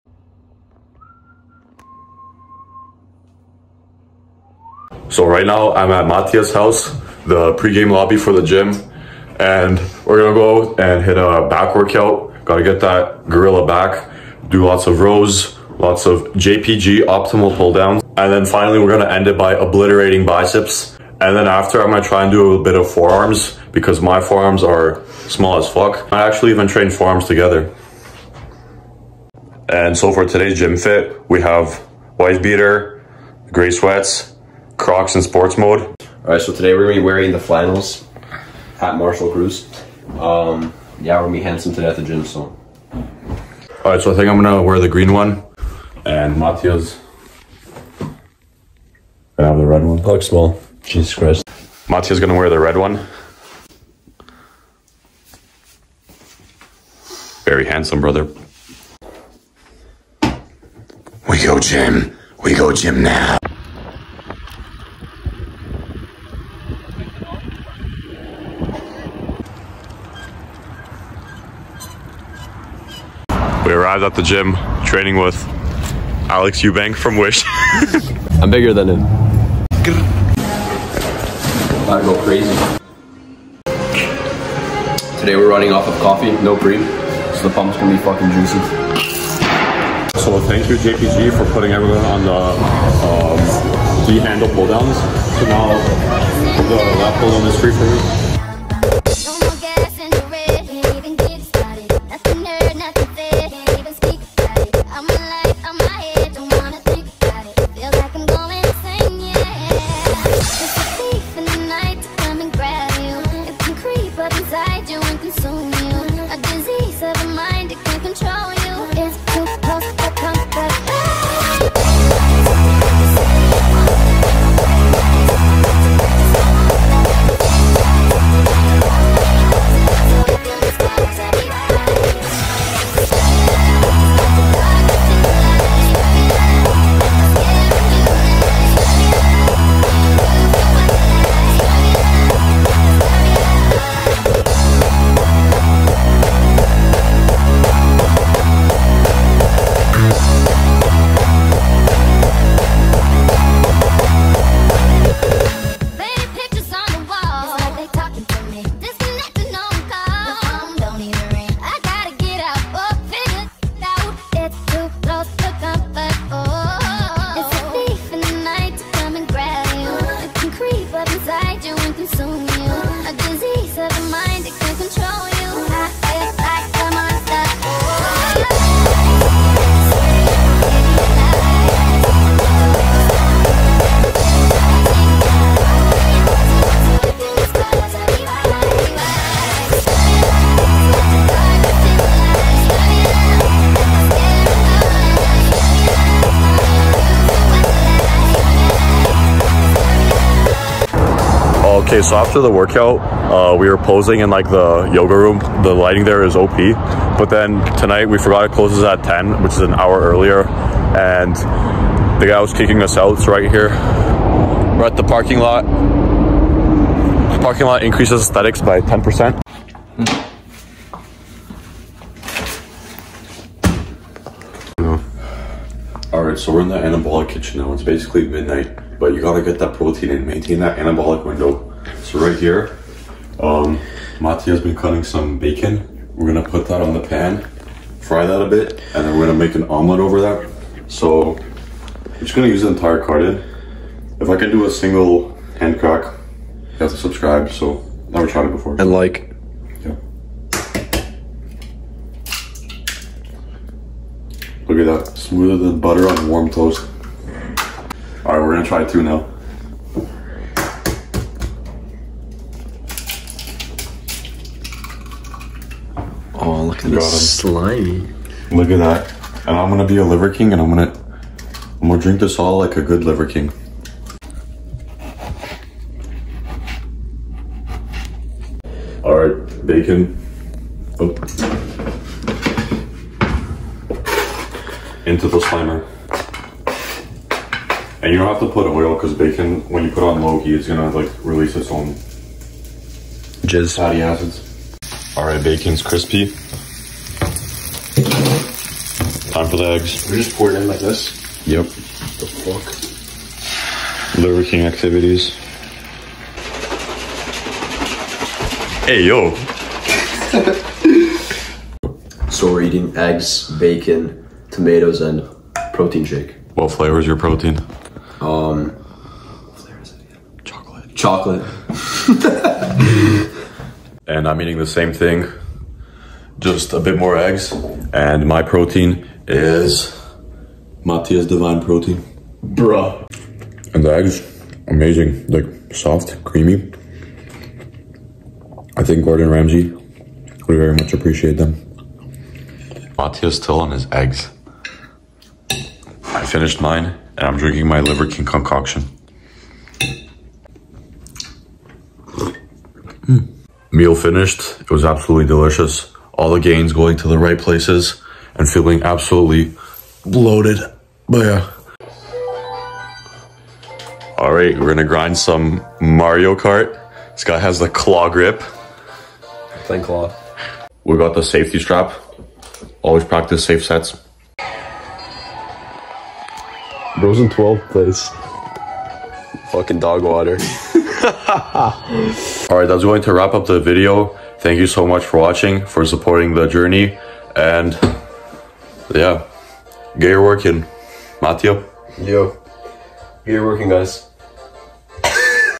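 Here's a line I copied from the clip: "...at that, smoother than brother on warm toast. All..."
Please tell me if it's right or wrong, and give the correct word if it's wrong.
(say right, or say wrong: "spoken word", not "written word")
wrong: "butter", not "brother".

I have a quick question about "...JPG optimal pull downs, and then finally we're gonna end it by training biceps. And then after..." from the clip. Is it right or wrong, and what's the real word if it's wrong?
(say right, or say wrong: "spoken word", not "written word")
wrong: "obliterating", not "training".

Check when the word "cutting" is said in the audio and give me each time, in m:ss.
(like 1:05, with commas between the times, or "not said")
3:54.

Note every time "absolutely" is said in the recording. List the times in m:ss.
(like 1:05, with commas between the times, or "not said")
5:54, 5:58.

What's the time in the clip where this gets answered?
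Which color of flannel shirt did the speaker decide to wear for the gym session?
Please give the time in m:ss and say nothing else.
0:44.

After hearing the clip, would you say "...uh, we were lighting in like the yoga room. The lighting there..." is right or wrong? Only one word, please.
wrong.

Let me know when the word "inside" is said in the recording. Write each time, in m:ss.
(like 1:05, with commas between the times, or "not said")
not said.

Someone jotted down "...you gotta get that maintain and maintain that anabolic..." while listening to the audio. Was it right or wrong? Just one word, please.
wrong.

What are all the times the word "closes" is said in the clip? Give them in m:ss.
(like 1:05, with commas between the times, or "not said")
3:28.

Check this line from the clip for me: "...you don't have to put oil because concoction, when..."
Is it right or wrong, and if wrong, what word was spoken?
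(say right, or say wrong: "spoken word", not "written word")
wrong: "bacon", not "concoction".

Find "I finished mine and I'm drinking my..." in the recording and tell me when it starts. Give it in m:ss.
5:45.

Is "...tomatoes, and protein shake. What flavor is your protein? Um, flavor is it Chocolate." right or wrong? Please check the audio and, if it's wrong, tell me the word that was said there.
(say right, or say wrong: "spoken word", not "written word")
right.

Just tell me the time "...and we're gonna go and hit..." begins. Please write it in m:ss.
0:09.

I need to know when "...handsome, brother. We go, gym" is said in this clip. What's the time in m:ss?
0:57.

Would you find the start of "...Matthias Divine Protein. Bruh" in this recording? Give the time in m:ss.
5:30.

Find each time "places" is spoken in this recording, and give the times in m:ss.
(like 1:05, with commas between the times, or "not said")
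5:57, 6:17.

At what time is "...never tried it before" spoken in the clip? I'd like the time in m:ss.
4:08.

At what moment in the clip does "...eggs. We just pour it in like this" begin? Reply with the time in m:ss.
4:59.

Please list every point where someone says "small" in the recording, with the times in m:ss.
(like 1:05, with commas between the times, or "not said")
0:25, 0:50.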